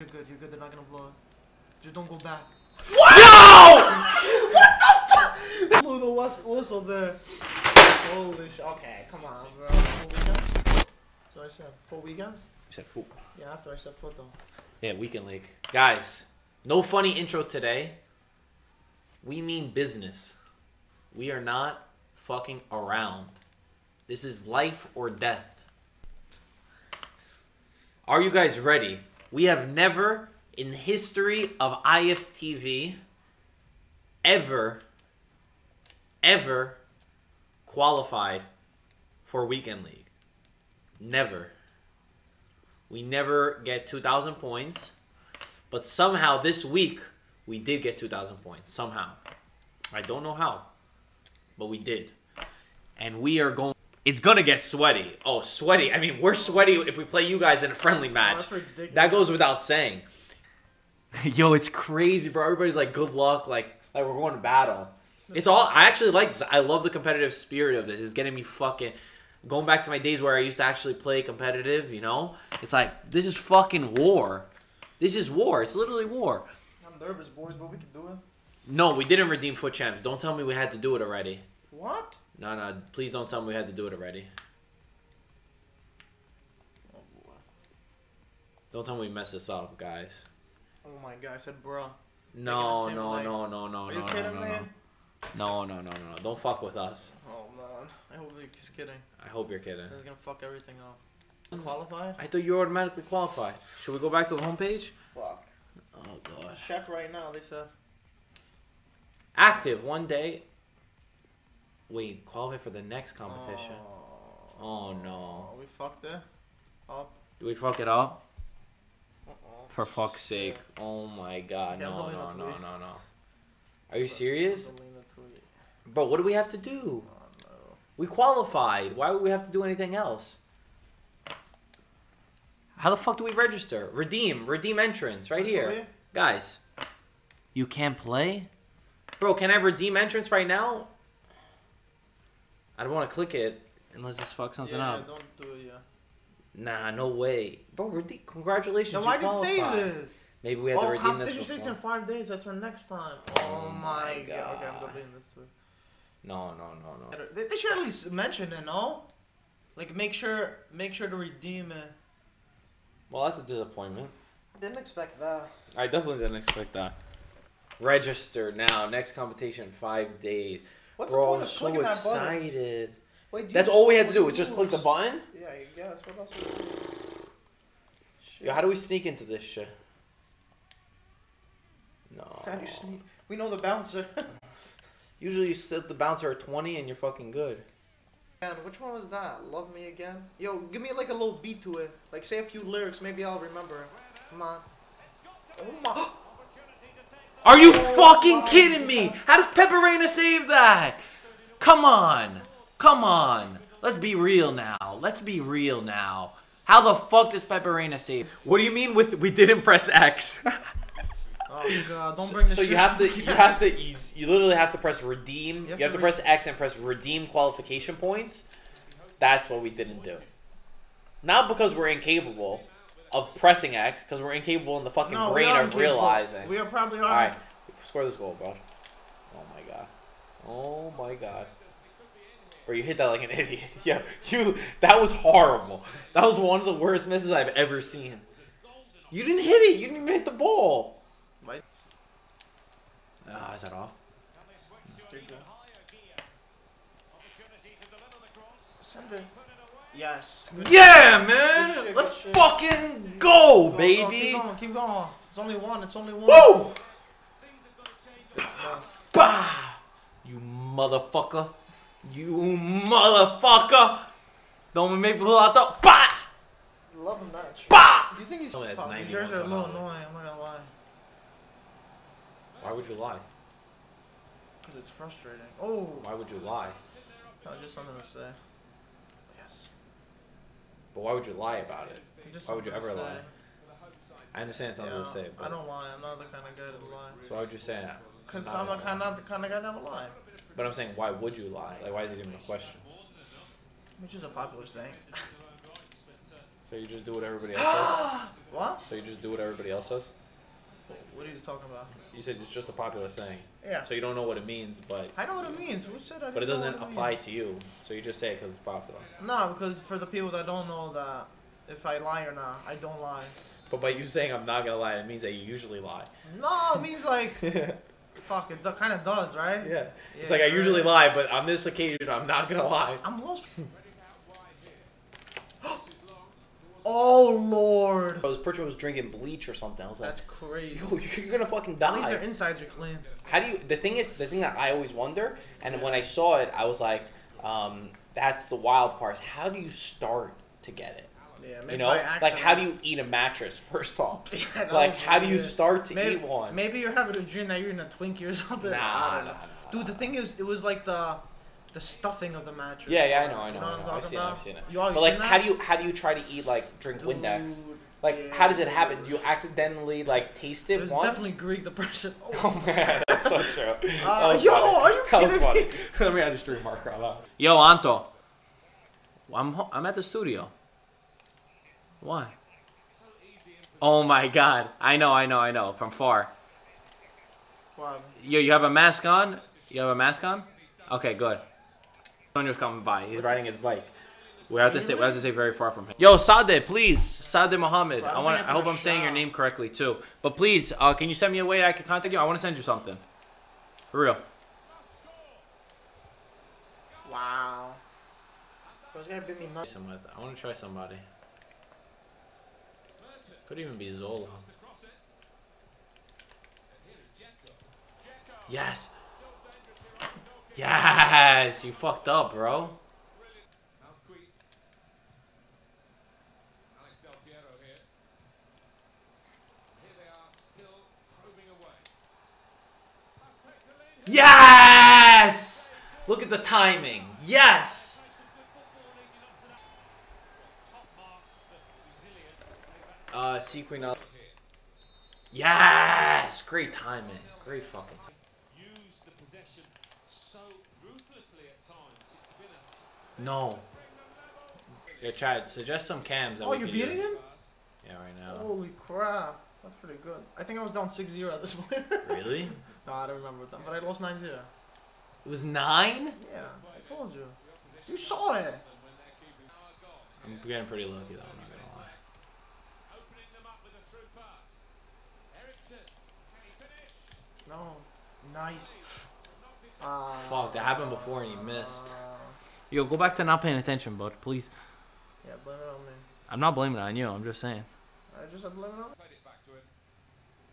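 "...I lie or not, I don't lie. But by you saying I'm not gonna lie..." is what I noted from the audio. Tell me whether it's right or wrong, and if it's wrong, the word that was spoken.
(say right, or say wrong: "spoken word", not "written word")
right.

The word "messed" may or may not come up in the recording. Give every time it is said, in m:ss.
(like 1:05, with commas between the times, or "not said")
1:29.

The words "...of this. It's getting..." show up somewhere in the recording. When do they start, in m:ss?
1:07.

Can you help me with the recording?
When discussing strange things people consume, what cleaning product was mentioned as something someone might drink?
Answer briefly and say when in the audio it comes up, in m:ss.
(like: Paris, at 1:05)
Windex, at 5:57.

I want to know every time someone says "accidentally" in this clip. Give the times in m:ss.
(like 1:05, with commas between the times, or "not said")
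5:59.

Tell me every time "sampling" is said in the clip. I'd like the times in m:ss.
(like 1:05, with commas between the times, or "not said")
not said.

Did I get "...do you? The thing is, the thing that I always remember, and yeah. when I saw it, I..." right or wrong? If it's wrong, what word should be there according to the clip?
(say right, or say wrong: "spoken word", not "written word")
wrong: "wonder", not "remember".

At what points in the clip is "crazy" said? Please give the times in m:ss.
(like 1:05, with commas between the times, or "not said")
1:01, 5:30.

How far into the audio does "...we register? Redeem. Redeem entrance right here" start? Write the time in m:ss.
2:13.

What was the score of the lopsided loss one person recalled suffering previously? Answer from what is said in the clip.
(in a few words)
9-0.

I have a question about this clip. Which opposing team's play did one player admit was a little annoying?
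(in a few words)
New Jersey.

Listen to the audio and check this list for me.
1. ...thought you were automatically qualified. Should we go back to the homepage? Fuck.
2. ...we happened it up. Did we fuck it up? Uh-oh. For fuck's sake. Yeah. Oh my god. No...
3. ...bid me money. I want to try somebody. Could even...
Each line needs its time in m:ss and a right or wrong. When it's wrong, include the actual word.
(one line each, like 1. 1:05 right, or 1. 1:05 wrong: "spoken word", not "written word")
1. 1:42 right
2. 1:55 wrong: "fucked", not "happened"
3. 6:39 right.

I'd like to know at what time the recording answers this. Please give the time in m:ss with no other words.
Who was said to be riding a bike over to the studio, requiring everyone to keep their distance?
6:22.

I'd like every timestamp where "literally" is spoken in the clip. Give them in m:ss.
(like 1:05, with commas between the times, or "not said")
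1:15, 3:34.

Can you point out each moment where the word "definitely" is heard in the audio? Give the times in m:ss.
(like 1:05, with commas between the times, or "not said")
2:45, 6:01.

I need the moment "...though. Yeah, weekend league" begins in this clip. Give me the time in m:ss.
0:14.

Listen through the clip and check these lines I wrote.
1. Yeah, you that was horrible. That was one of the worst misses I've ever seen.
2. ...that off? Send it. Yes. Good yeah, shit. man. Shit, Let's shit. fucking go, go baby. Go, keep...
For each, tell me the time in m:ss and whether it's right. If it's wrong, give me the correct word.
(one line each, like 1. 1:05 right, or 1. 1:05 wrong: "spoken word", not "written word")
1. 3:53 right
2. 4:03 right.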